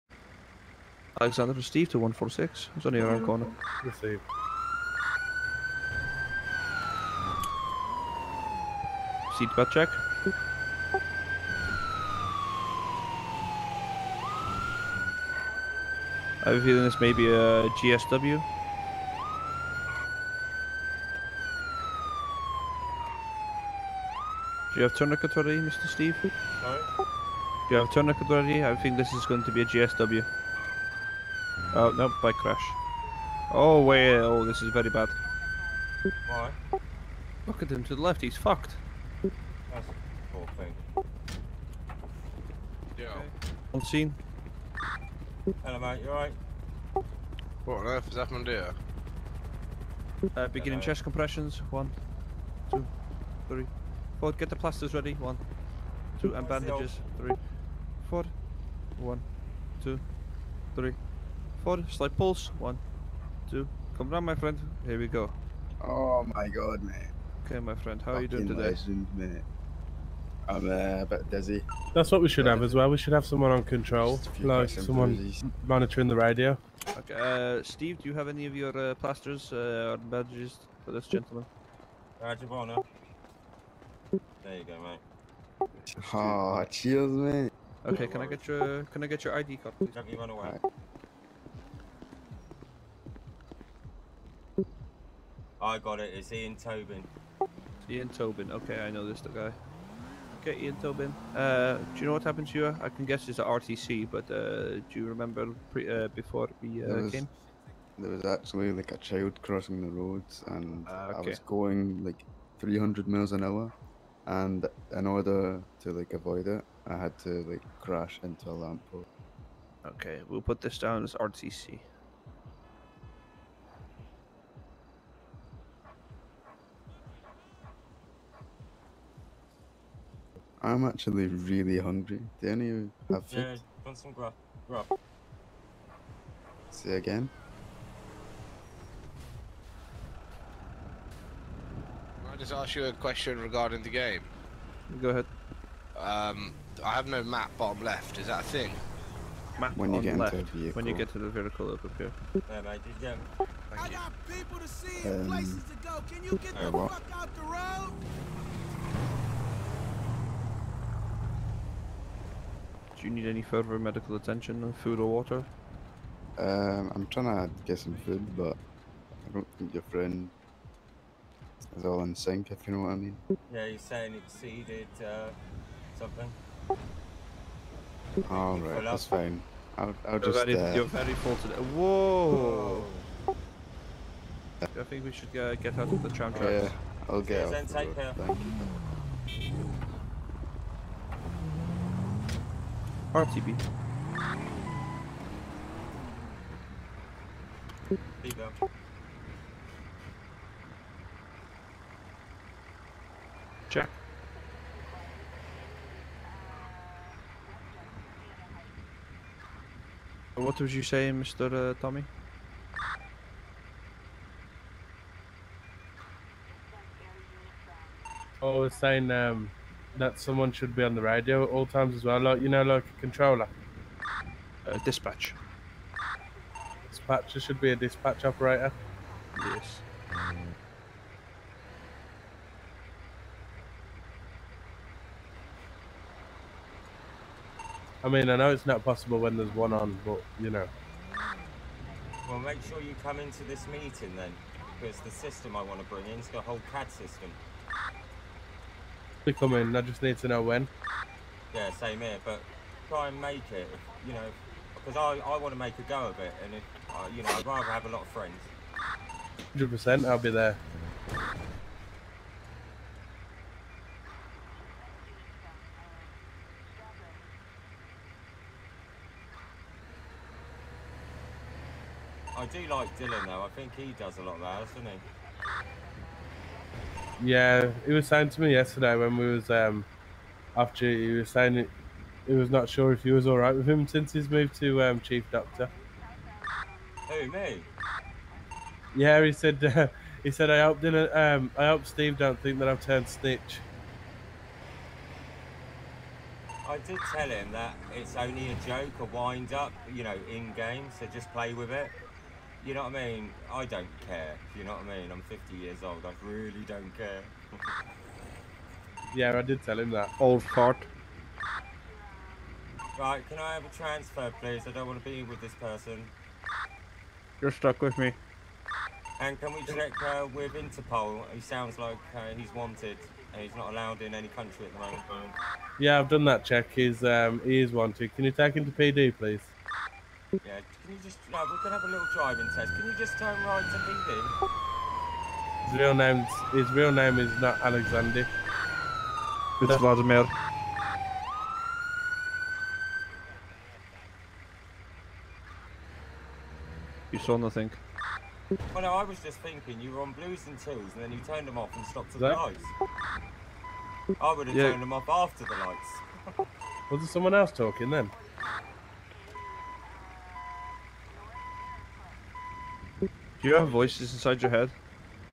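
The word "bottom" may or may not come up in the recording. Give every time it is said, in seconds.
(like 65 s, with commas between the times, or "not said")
147 s.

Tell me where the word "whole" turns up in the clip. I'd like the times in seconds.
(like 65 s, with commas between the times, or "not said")
40 s, 246 s.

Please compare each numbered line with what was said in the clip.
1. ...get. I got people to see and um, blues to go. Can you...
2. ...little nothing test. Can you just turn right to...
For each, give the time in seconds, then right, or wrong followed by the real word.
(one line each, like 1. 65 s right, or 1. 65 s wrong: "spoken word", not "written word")
1. 153 s wrong: "places", not "blues"
2. 331 s wrong: "driving", not "nothing".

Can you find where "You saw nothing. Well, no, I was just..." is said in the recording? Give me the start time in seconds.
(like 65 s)
347 s.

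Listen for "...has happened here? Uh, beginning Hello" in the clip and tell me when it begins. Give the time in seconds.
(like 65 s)
48 s.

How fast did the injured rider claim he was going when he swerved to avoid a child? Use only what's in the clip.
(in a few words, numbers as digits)
300 miles an hour.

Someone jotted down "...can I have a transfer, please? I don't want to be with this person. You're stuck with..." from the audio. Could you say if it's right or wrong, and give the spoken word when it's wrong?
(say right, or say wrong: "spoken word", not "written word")
right.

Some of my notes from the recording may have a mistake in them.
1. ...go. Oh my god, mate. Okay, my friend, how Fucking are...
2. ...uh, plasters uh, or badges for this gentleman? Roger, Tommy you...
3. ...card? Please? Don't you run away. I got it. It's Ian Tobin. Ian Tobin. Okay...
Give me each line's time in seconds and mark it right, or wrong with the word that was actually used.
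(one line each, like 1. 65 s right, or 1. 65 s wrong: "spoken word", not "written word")
1. 65 s right
2. 78 s wrong: "There", not "Tommy"
3. 89 s right.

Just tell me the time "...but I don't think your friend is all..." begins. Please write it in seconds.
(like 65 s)
168 s.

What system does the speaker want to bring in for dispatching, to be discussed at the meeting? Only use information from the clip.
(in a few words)
CAD system.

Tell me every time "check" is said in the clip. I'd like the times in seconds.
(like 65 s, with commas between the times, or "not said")
9 s, 203 s, 319 s, 326 s.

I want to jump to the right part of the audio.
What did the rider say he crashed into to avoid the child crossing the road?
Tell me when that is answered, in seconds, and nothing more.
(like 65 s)
118 s.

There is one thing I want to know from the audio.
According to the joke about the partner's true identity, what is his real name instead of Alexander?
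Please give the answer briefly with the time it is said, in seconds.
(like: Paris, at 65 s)
Vladimir, at 339 s.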